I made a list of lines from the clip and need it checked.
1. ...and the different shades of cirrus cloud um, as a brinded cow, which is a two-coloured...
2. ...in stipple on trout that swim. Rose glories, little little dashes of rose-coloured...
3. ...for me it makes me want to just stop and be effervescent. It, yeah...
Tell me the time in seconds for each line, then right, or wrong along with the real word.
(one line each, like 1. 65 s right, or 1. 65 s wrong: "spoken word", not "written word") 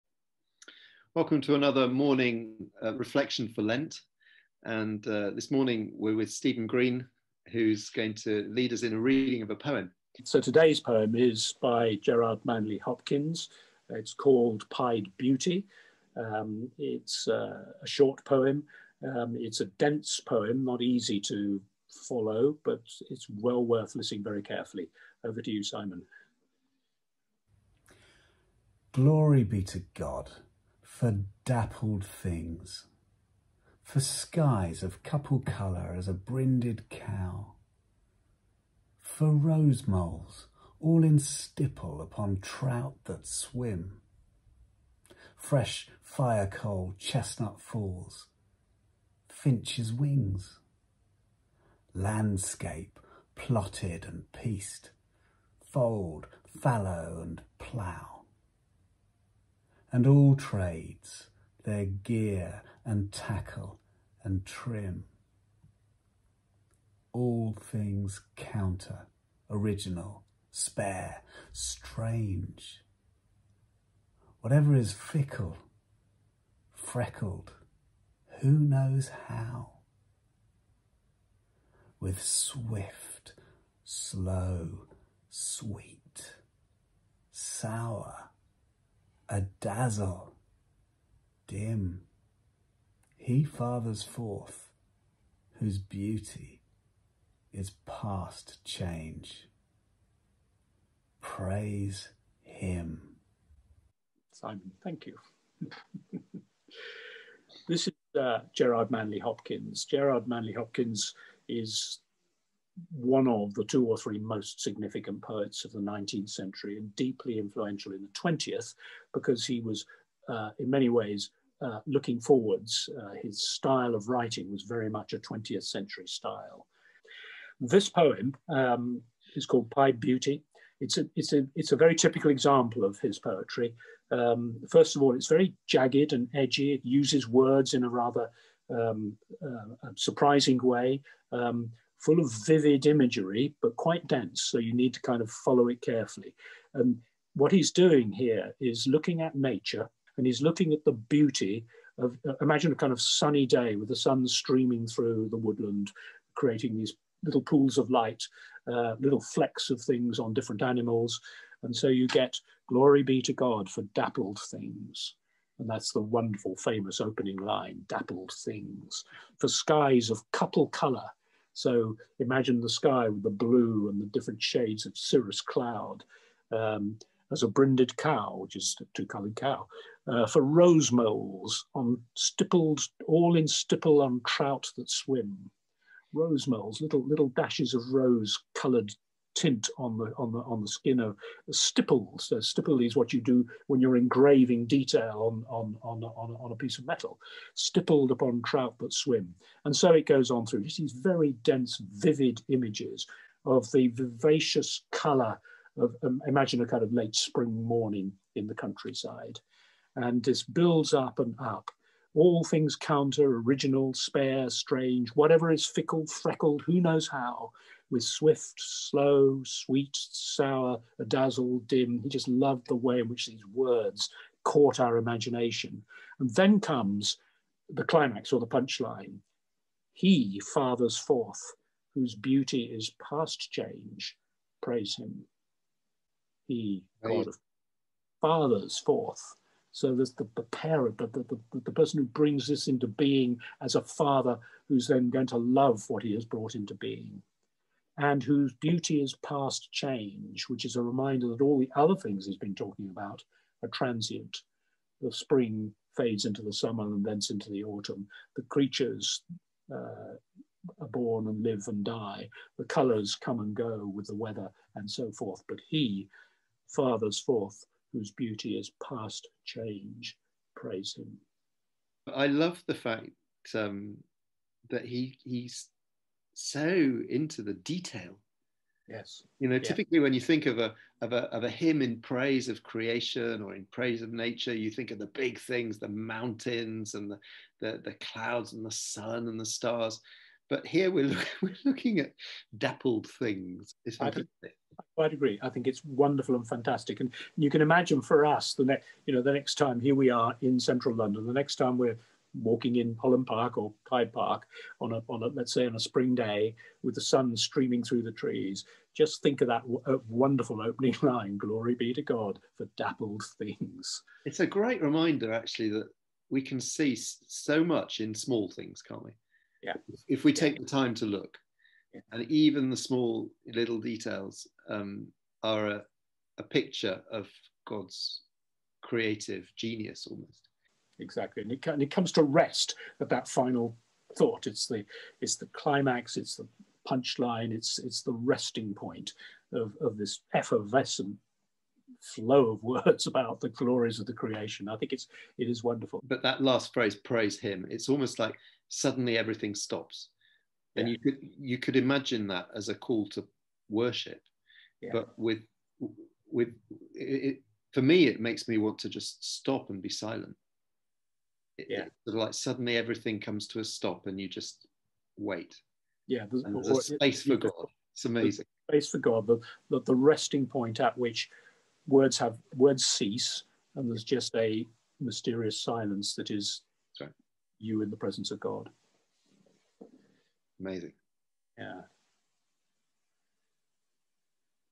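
1. 173 s right
2. 183 s wrong: "moles", not "glories"
3. 357 s wrong: "silent", not "effervescent".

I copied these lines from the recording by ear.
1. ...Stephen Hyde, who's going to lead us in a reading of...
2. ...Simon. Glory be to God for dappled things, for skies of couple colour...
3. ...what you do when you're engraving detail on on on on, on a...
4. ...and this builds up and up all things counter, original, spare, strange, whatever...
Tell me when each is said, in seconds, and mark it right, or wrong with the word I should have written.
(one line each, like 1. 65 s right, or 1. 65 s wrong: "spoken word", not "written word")
1. 6 s wrong: "Green", not "Hyde"
2. 25 s right
3. 192 s right
4. 209 s right.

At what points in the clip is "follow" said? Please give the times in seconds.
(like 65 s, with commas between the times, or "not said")
22 s, 145 s.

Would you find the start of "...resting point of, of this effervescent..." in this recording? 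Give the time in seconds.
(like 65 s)
338 s.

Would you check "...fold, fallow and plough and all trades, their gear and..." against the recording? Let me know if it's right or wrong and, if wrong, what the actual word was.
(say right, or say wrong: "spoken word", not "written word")
right.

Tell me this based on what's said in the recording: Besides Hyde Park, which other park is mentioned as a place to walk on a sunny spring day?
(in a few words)
Holland Park.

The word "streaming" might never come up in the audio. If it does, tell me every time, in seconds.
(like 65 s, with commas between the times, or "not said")
154 s, 307 s.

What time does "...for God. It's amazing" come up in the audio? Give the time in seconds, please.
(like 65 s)
367 s.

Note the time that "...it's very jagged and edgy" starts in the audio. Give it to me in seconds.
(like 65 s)
135 s.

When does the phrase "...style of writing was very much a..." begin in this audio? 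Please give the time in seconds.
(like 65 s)
123 s.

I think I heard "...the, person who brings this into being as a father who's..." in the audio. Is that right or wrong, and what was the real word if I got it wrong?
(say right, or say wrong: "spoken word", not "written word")
right.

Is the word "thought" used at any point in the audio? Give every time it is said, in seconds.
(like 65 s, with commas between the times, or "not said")
334 s.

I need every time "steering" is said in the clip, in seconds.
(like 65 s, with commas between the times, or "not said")
not said.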